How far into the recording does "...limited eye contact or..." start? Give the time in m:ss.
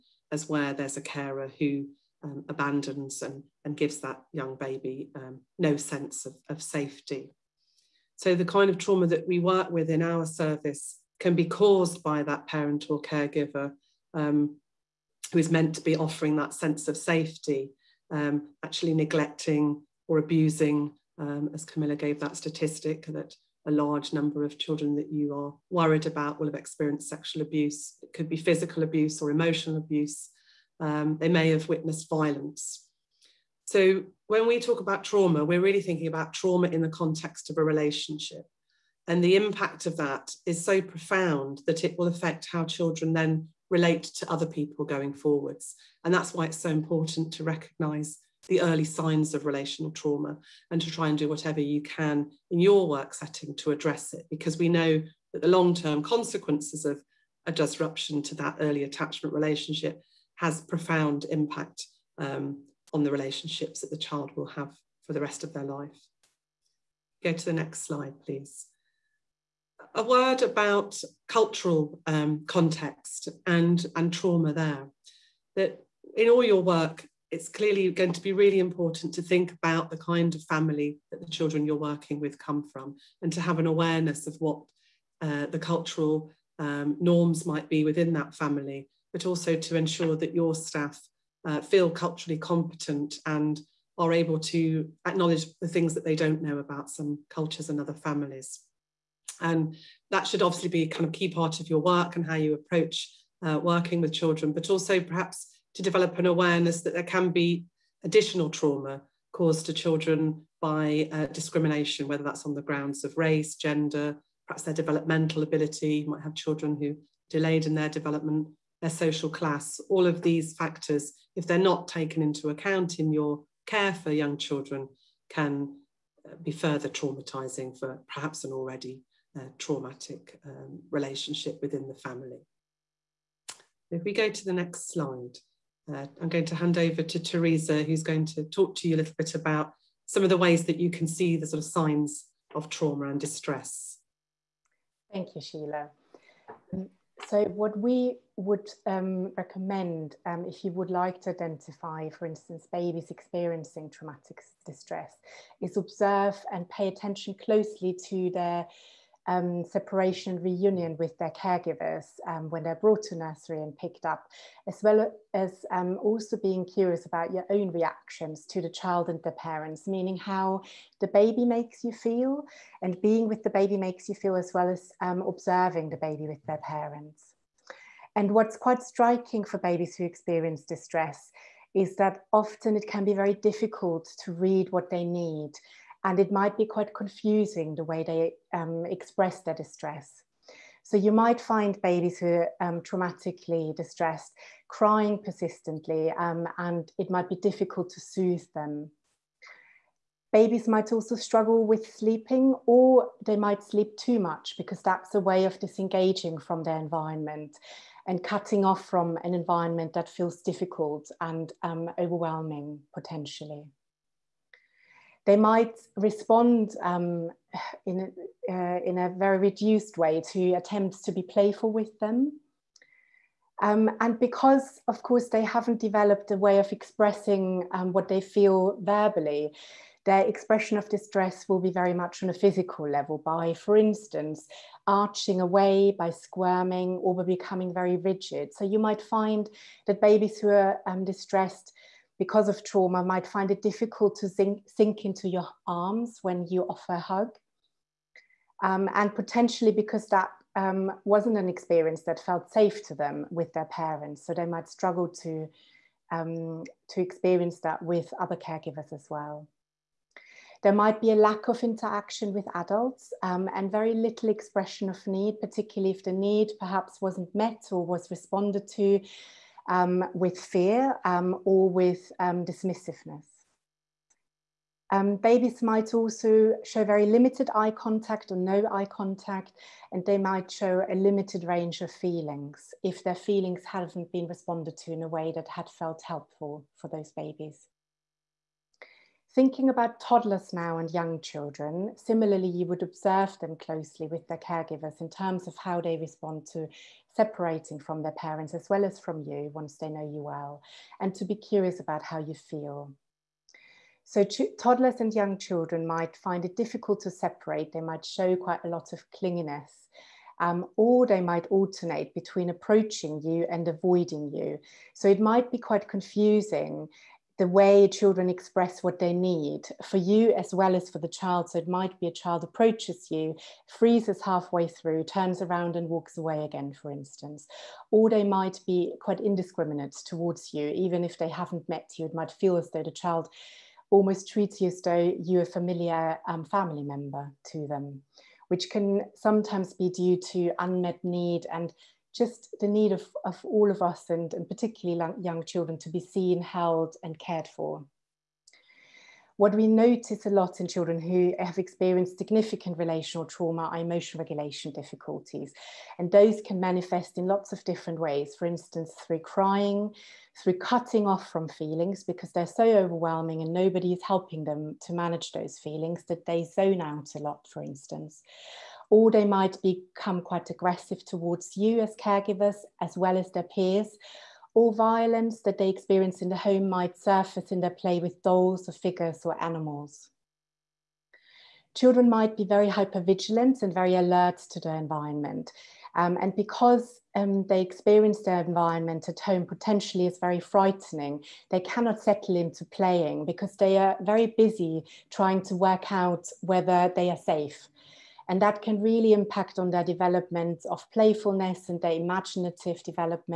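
4:37.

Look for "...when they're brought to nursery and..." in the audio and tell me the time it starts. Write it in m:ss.
2:42.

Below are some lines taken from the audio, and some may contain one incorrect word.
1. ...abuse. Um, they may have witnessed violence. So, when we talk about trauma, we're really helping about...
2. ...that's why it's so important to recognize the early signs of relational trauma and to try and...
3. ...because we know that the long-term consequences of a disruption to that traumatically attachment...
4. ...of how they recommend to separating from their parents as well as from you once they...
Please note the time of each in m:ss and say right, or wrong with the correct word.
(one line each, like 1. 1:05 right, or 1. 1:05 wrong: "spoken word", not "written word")
1. 0:29 wrong: "thinking", not "helping"
2. 0:46 right
3. 0:54 wrong: "early", not "traumatically"
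4. 4:55 wrong: "respond", not "recommend".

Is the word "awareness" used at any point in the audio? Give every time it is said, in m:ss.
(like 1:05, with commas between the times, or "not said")
1:23, 1:46.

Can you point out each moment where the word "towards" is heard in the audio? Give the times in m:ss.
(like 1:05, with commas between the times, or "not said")
5:30, 6:11.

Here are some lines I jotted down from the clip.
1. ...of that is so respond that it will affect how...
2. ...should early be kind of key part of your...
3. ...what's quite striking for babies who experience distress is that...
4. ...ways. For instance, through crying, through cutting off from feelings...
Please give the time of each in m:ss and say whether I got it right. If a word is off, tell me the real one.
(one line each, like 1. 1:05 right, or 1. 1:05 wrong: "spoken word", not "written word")
1. 0:39 wrong: "profound", not "respond"
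2. 1:40 wrong: "obviously", not "early"
3. 2:58 right
4. 5:57 right.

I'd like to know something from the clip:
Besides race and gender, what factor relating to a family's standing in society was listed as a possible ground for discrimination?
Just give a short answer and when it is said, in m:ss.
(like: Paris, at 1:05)
social class, at 1:58.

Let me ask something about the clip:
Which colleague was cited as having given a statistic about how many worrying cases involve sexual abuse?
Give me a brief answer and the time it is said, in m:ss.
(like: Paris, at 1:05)
Camilla, at 0:21.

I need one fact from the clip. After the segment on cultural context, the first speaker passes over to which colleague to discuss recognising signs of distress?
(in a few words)
Theresa.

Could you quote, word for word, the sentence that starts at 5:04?
So, toddlers and young children might find it difficult to separate, they might show quite a lot of clinginess.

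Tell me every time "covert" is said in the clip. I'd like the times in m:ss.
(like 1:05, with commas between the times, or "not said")
not said.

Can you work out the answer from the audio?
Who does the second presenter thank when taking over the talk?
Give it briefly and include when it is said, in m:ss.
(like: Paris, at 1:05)
Sheila, at 2:25.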